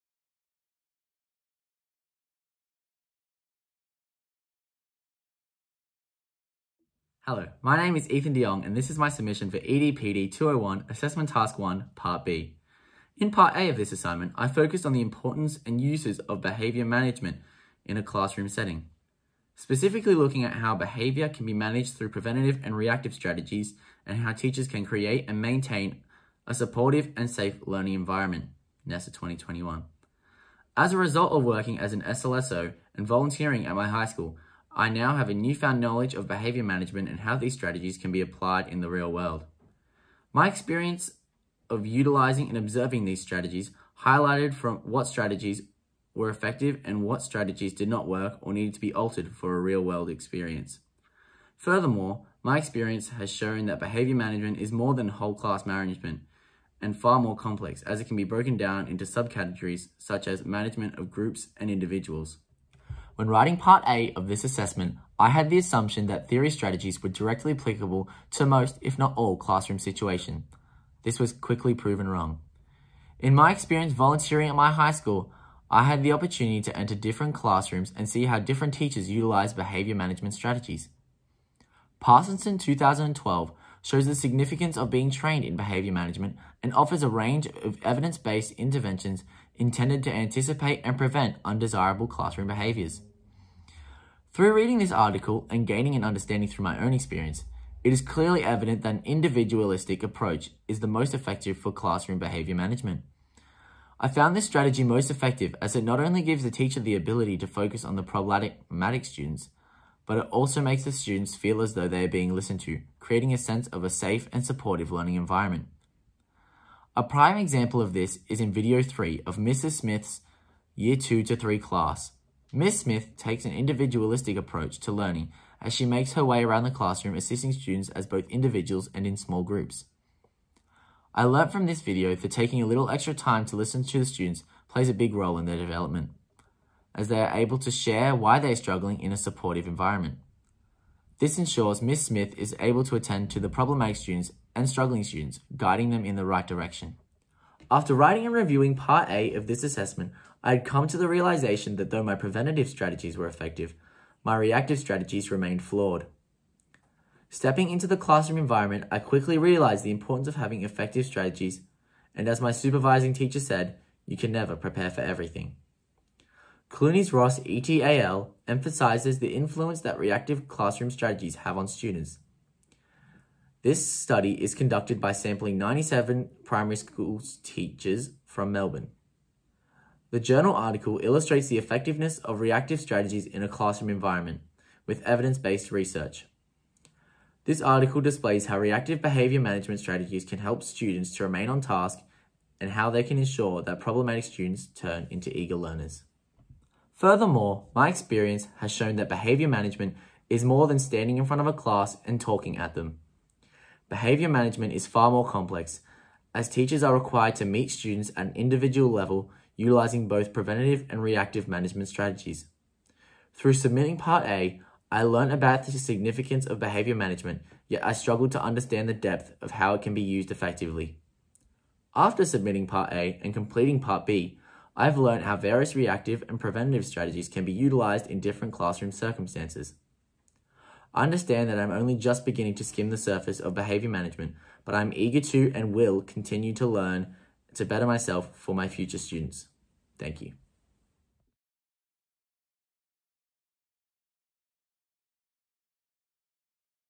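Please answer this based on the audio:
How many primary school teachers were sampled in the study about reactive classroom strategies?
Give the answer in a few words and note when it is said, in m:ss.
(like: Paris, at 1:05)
97, at 2:55.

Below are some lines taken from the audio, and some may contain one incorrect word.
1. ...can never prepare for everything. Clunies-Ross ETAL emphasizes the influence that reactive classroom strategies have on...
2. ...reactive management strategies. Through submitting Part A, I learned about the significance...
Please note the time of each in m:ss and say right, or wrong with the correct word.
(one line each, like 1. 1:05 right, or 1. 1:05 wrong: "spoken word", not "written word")
1. 2:44 right
2. 3:31 right.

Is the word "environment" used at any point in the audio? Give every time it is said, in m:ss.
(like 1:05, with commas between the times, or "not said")
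0:27, 1:55, 2:19, 2:38, 3:03.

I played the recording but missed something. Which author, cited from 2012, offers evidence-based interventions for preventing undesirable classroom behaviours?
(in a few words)
Parsonson.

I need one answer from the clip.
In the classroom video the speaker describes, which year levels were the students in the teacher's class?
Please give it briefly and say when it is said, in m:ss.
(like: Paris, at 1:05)
Year 2 to 3, at 2:00.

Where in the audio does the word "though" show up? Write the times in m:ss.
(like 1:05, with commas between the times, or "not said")
1:51, 2:31.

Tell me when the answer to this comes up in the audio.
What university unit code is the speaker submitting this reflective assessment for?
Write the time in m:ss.
0:09.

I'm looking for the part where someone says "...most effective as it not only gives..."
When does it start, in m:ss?
1:44.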